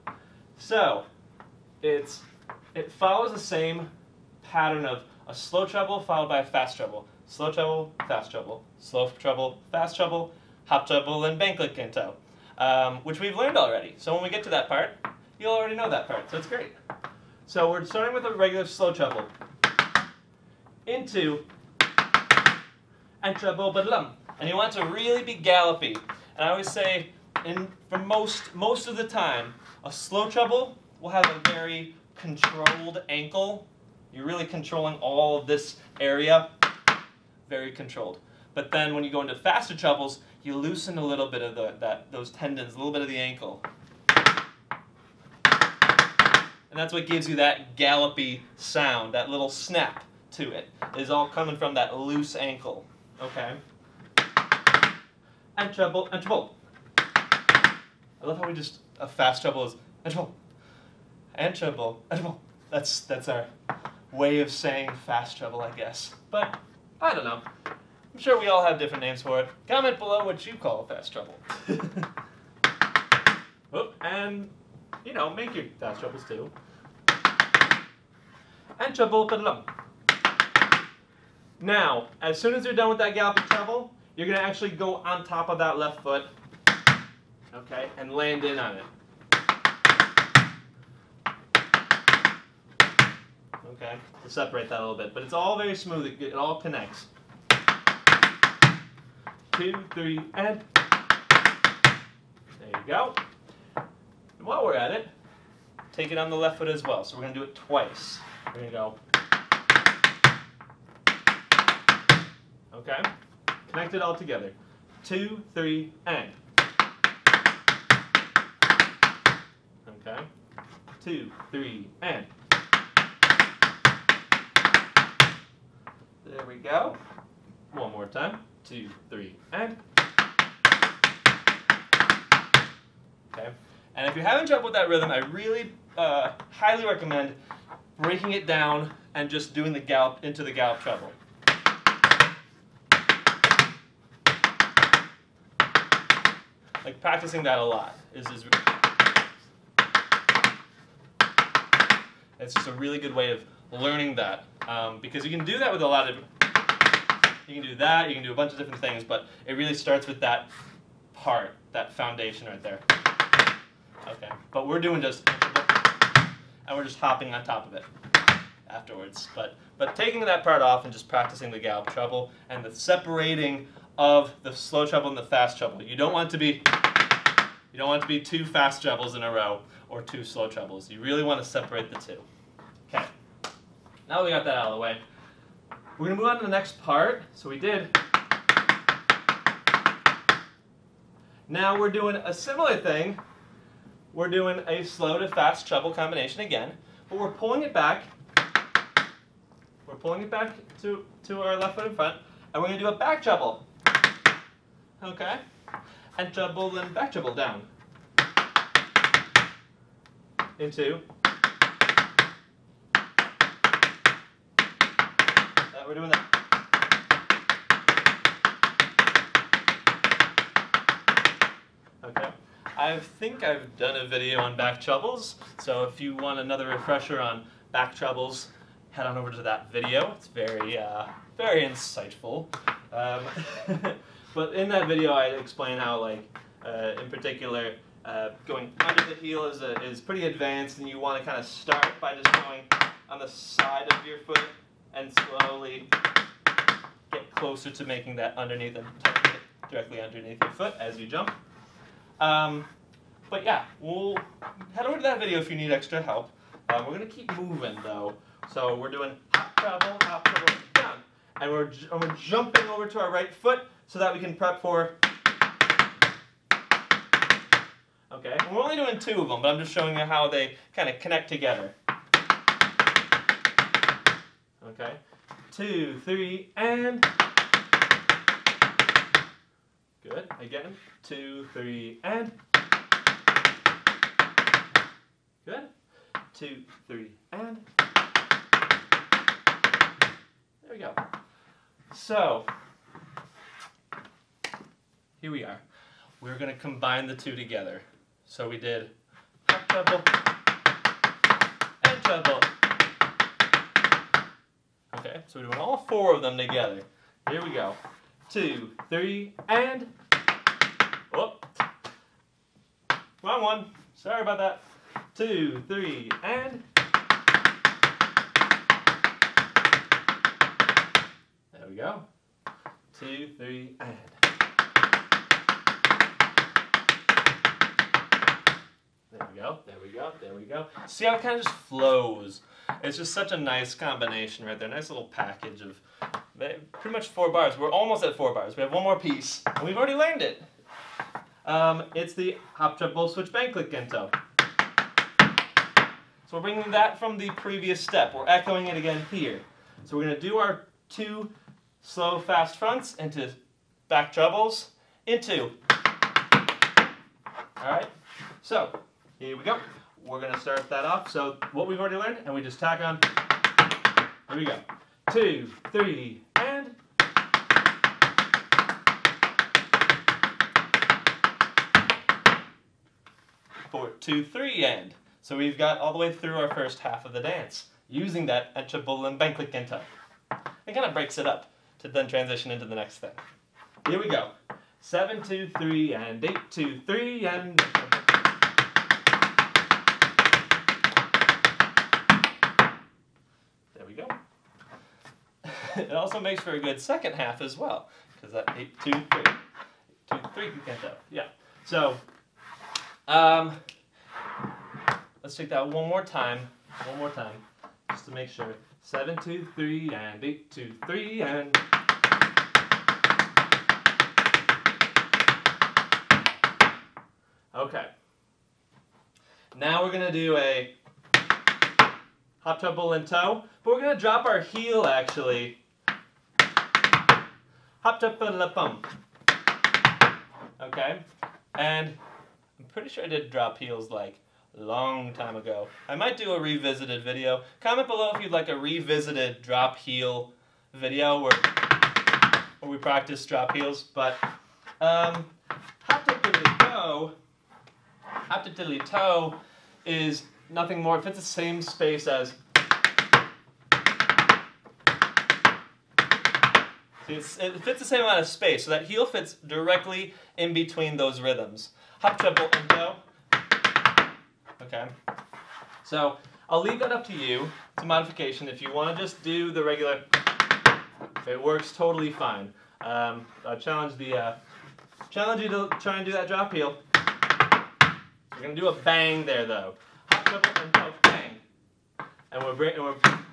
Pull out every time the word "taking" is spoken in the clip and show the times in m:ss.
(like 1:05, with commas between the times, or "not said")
2:49.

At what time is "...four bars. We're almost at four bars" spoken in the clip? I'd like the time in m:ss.
5:37.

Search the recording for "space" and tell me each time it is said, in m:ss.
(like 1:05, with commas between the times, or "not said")
7:31, 7:38.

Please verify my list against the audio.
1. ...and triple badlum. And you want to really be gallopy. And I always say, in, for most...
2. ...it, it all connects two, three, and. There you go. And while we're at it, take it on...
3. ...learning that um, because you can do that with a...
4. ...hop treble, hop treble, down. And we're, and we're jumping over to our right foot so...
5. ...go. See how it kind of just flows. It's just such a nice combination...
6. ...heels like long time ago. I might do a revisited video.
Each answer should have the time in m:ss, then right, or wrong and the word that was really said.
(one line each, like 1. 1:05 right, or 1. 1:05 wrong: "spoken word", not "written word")
1. 0:23 wrong: "treble", not "triple"
2. 1:36 right
3. 2:33 right
4. 4:19 right
5. 5:30 right
6. 7:13 right.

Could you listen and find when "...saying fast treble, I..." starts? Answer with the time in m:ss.
1:04.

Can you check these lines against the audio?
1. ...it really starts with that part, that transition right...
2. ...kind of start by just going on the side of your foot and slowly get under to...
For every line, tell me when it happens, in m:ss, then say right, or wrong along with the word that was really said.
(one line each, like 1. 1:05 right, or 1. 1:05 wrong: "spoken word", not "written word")
1. 2:39 wrong: "foundation", not "transition"
2. 4:01 wrong: "closer", not "under".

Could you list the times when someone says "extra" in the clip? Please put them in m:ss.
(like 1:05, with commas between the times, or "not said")
4:15.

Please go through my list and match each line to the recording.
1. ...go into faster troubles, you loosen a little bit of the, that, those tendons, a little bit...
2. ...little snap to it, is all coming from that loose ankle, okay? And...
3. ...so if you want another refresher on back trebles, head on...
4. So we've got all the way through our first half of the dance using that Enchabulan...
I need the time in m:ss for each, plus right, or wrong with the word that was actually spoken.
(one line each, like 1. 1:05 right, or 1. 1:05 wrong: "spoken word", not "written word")
1. 0:39 wrong: "trebles", not "troubles"
2. 0:49 right
3. 3:45 right
4. 6:15 right.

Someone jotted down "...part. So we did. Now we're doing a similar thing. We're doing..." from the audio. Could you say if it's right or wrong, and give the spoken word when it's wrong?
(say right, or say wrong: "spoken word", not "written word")
right.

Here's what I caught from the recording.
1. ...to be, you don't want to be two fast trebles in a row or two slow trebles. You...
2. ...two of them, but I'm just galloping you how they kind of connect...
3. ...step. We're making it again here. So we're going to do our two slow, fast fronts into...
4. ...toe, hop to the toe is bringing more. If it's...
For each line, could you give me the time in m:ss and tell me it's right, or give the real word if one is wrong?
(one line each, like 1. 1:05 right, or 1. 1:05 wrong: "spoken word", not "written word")
1. 2:56 right
2. 4:29 wrong: "showing", not "galloping"
3. 5:47 wrong: "echoing", not "making"
4. 7:26 wrong: "nothing", not "bringing".